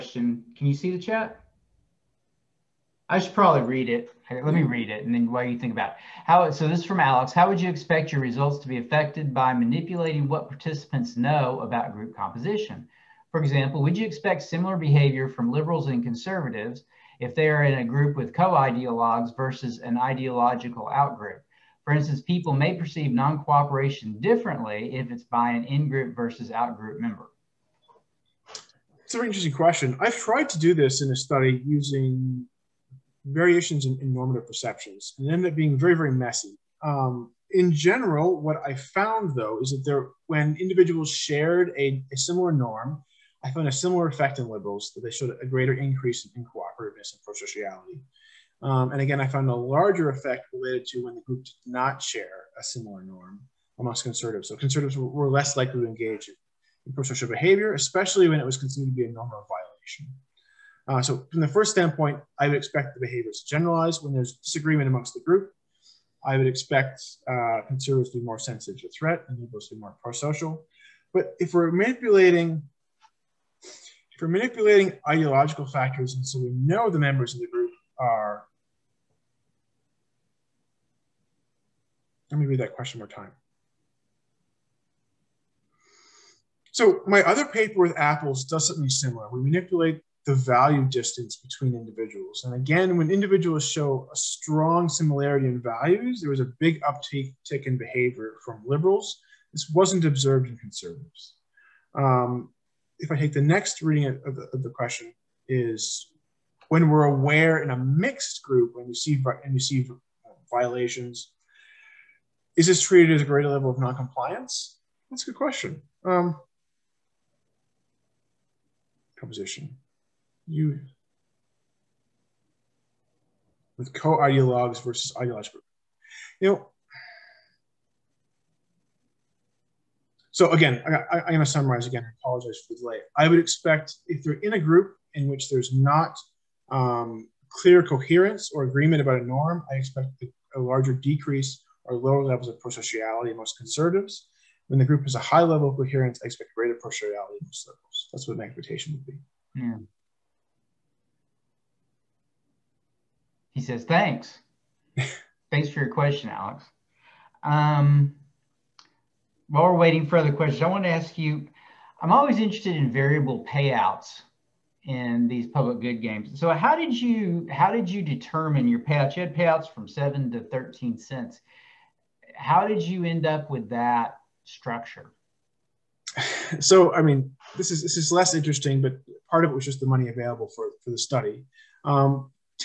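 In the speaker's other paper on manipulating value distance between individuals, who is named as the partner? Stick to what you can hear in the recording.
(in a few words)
apples.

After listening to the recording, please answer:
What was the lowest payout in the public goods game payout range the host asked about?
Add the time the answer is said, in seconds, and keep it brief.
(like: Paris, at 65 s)
7 cents, at 169 s.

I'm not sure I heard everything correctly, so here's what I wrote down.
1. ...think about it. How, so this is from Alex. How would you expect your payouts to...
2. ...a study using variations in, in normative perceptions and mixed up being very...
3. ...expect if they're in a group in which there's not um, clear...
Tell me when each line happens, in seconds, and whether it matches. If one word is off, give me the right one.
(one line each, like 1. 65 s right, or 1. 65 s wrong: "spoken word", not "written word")
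1. 5 s wrong: "results", not "payouts"
2. 31 s wrong: "ended", not "mixed"
3. 133 s right.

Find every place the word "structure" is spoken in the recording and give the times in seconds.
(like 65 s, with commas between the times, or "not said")
174 s.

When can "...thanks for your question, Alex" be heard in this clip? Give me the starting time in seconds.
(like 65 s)
155 s.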